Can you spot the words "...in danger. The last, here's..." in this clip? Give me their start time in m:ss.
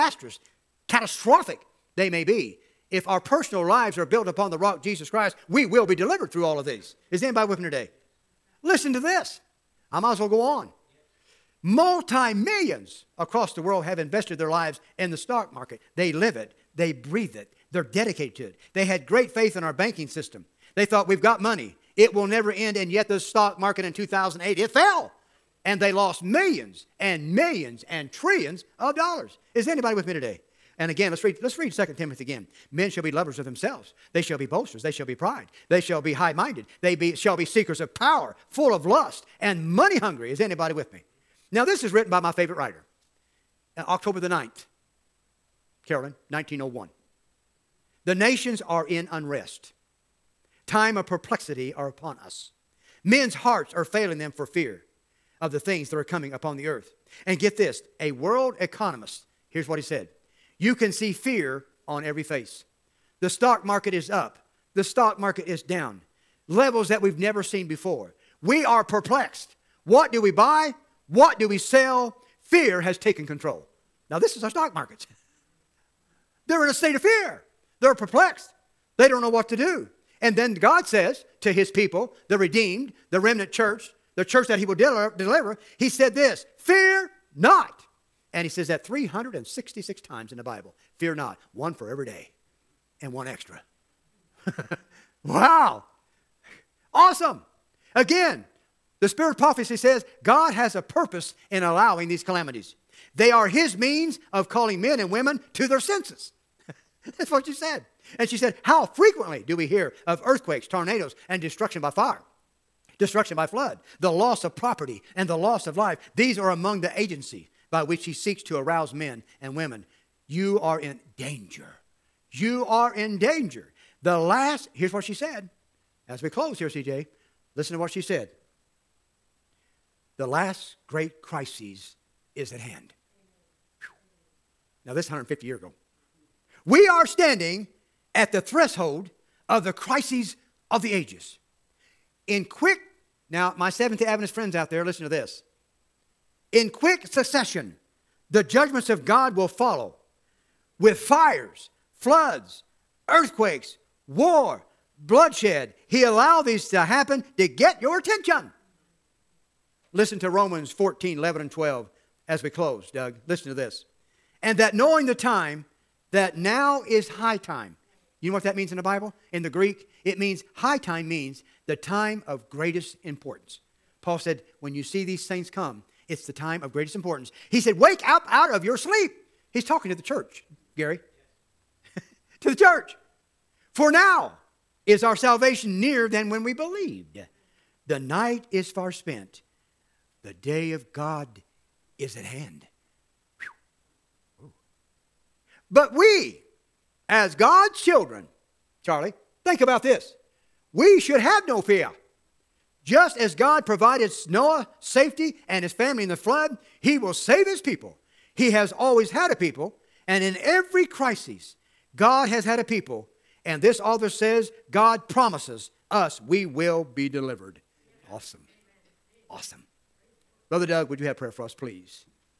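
2:02.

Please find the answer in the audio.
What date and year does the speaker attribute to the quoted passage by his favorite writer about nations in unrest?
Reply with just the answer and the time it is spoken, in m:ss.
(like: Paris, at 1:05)
October 9, 1901, at 0:43.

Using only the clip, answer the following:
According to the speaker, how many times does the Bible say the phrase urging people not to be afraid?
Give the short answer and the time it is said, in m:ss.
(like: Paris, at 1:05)
366, at 1:28.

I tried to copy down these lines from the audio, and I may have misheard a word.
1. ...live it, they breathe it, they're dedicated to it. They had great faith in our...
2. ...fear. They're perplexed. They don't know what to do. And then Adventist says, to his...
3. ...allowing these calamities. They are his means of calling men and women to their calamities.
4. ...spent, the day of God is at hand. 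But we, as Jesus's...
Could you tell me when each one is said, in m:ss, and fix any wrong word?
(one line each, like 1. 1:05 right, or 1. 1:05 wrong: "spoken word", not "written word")
1. 0:16 right
2. 1:17 wrong: "God", not "Adventist"
3. 1:41 wrong: "senses", not "calamities"
4. 3:08 wrong: "God", not "Jesus".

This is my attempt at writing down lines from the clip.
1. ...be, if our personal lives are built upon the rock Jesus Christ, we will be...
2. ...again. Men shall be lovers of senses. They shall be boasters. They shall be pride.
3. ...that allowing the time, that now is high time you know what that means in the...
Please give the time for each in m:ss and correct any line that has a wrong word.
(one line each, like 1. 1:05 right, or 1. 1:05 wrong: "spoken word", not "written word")
1. 0:02 right
2. 0:32 wrong: "themselves", not "senses"
3. 2:44 wrong: "knowing", not "allowing".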